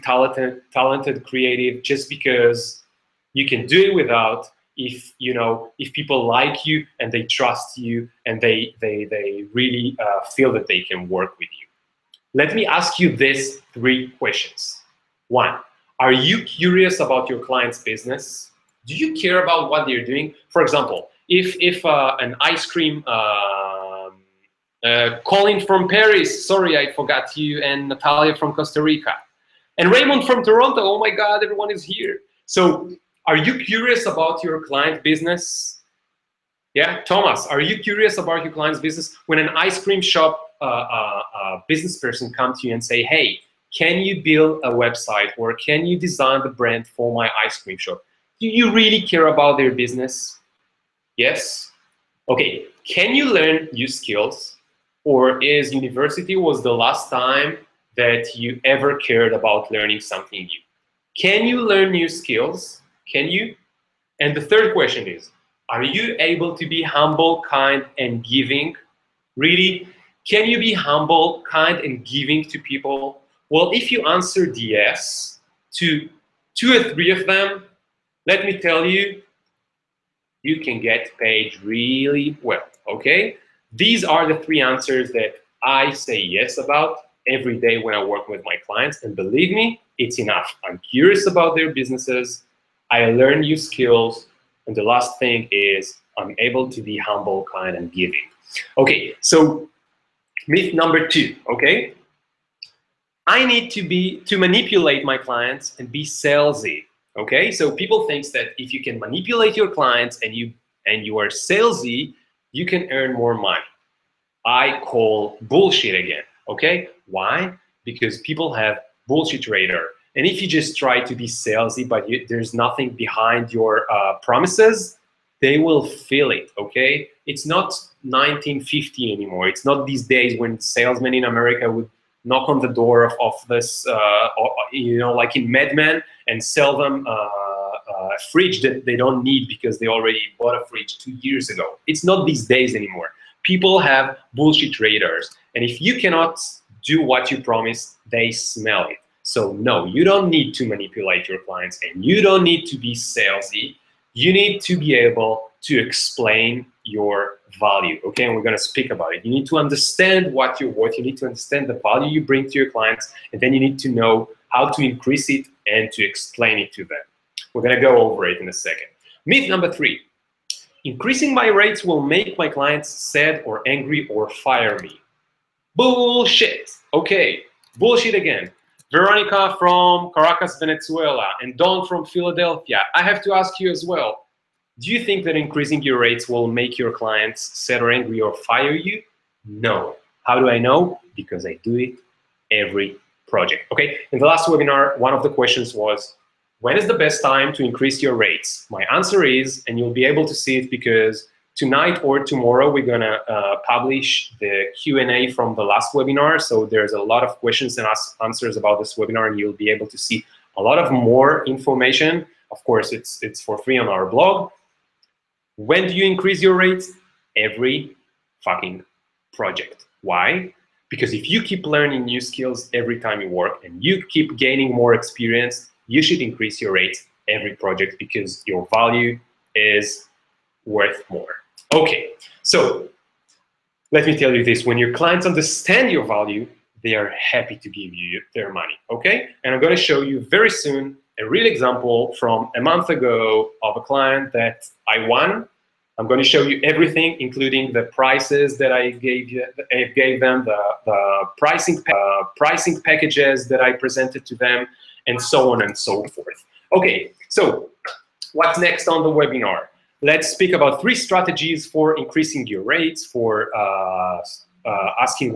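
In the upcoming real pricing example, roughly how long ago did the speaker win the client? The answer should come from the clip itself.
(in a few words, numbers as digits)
A month ago.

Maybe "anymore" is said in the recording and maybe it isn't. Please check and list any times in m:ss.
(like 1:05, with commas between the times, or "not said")
2:09, 2:22.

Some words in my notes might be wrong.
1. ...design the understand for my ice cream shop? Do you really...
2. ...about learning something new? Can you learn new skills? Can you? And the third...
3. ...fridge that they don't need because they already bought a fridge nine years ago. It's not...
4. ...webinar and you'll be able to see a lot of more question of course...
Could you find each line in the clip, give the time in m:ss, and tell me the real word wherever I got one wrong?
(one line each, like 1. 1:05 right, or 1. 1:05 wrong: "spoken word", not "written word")
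1. 0:45 wrong: "brand", not "understand"
2. 0:59 right
3. 2:18 wrong: "two", not "nine"
4. 3:28 wrong: "information", not "question".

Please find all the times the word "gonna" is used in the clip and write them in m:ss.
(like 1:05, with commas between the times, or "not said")
2:38, 2:47, 3:59.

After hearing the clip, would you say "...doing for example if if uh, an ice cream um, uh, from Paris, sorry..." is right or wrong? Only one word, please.
right.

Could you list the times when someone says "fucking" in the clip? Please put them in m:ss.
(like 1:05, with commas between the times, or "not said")
3:38.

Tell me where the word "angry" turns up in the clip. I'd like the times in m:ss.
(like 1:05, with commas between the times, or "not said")
2:53, 3:07.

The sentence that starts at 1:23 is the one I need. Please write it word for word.
These are the three answers that I say yes about every day when I work with my clients.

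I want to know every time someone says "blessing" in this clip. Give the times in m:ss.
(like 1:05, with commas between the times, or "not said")
not said.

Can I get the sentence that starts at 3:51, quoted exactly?
Okay, so let me tell you this.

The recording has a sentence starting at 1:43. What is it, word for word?
I need to be to manipulate my clients and be salesy.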